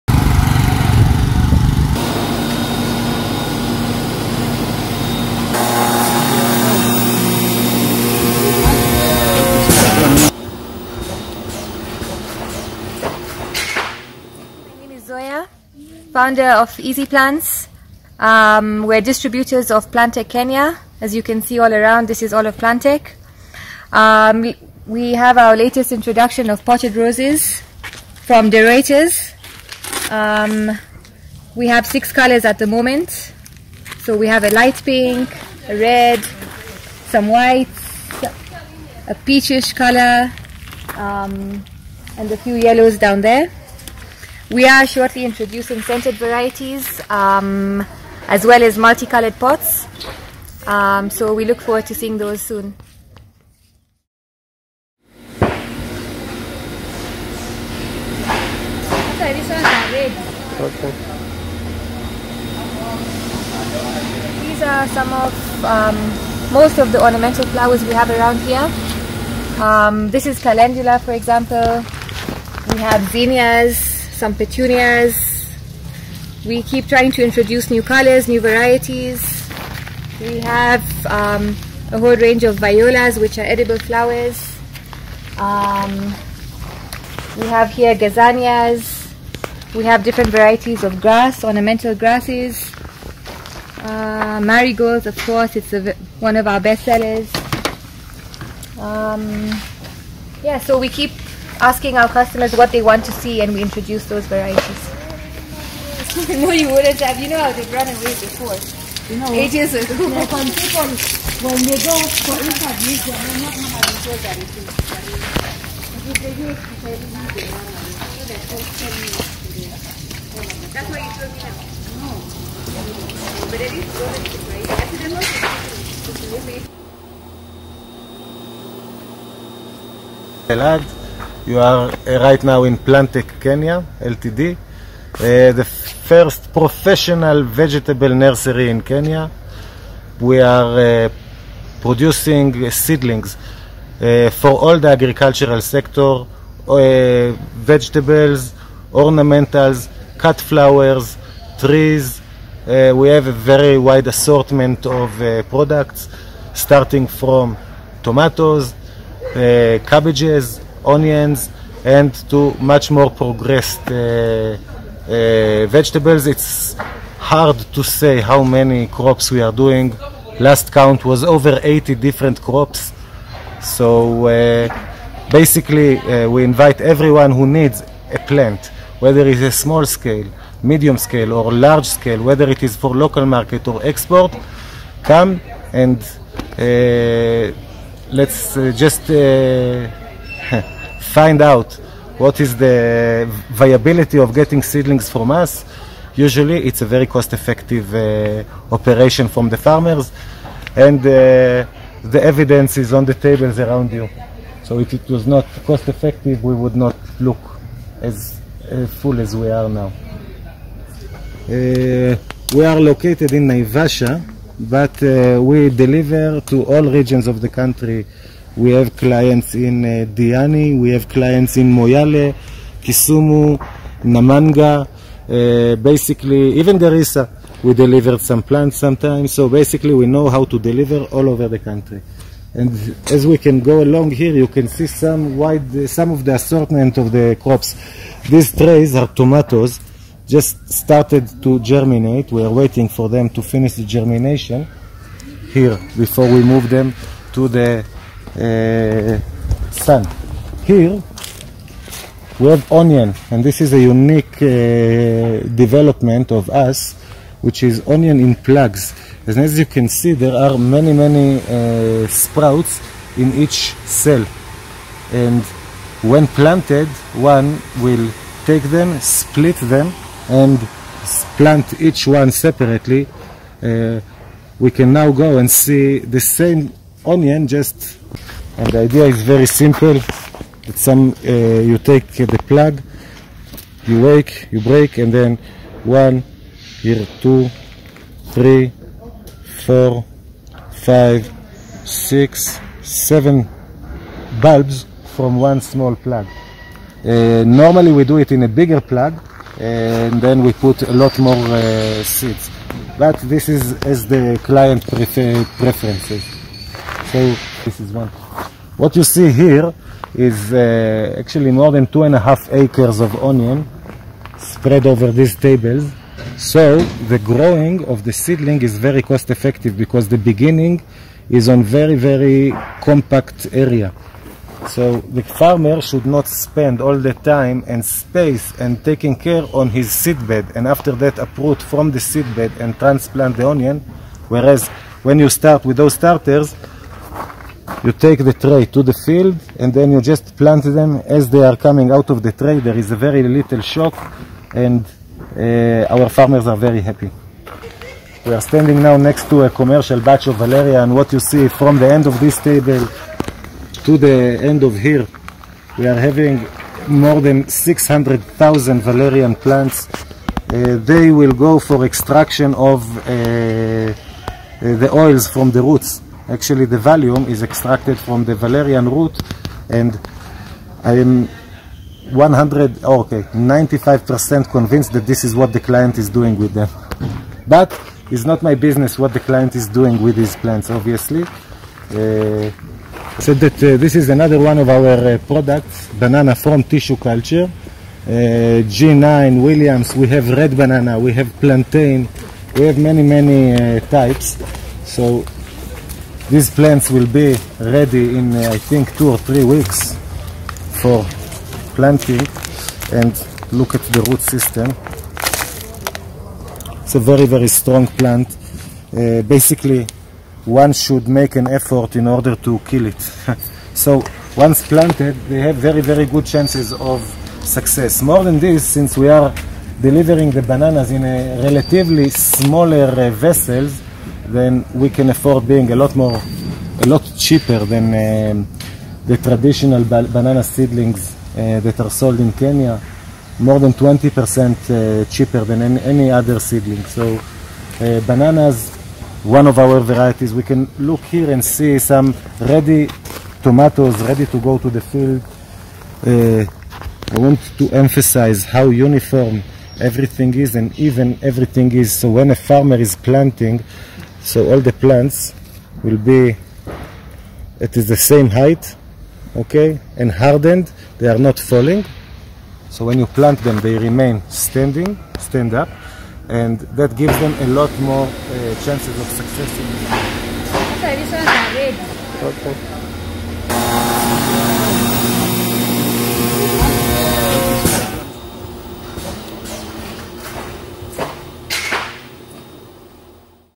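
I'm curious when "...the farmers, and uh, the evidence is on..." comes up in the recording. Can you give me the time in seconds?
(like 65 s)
199 s.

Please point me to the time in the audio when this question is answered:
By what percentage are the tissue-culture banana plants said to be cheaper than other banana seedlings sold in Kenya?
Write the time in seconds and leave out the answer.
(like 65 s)
433 s.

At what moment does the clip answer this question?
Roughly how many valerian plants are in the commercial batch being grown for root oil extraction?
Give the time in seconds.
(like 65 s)
356 s.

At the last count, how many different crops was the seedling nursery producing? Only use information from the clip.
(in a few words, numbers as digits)
over 80.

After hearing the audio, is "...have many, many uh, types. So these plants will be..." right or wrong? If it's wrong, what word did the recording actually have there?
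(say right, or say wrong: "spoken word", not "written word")
right.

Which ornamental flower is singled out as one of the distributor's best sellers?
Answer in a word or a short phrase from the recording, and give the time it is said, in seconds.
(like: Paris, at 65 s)
marigolds, at 94 s.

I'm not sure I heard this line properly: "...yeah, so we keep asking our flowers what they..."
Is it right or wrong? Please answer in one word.
wrong.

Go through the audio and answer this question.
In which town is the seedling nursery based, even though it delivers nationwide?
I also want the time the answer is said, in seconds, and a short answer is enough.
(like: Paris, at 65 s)
Naivasha, at 213 s.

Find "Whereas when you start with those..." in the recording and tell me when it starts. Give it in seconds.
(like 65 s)
334 s.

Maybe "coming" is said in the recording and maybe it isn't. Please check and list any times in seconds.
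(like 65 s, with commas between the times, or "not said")
341 s.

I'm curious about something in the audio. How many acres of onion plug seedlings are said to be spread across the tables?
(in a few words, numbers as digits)
more than 2.5 acres.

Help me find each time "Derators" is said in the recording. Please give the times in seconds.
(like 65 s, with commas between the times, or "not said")
28 s.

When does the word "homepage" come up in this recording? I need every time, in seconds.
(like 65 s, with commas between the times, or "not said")
not said.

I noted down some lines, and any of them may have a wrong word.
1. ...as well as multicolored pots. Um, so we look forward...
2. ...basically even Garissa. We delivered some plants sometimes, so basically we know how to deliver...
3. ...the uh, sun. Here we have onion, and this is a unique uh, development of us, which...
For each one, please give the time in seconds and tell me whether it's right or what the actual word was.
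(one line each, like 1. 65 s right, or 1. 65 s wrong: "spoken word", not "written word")
1. 48 s right
2. 225 s right
3. 247 s right.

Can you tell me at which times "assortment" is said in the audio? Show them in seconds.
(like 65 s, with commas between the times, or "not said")
154 s, 236 s.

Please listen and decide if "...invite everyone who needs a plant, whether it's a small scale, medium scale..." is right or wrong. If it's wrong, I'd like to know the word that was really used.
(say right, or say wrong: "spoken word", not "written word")
right.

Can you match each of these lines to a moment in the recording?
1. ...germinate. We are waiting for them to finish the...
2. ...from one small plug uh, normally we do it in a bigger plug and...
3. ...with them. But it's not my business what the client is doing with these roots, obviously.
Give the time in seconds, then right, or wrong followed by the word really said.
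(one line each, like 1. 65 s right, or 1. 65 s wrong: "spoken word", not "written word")
1. 241 s right
2. 295 s right
3. 376 s wrong: "plants", not "roots".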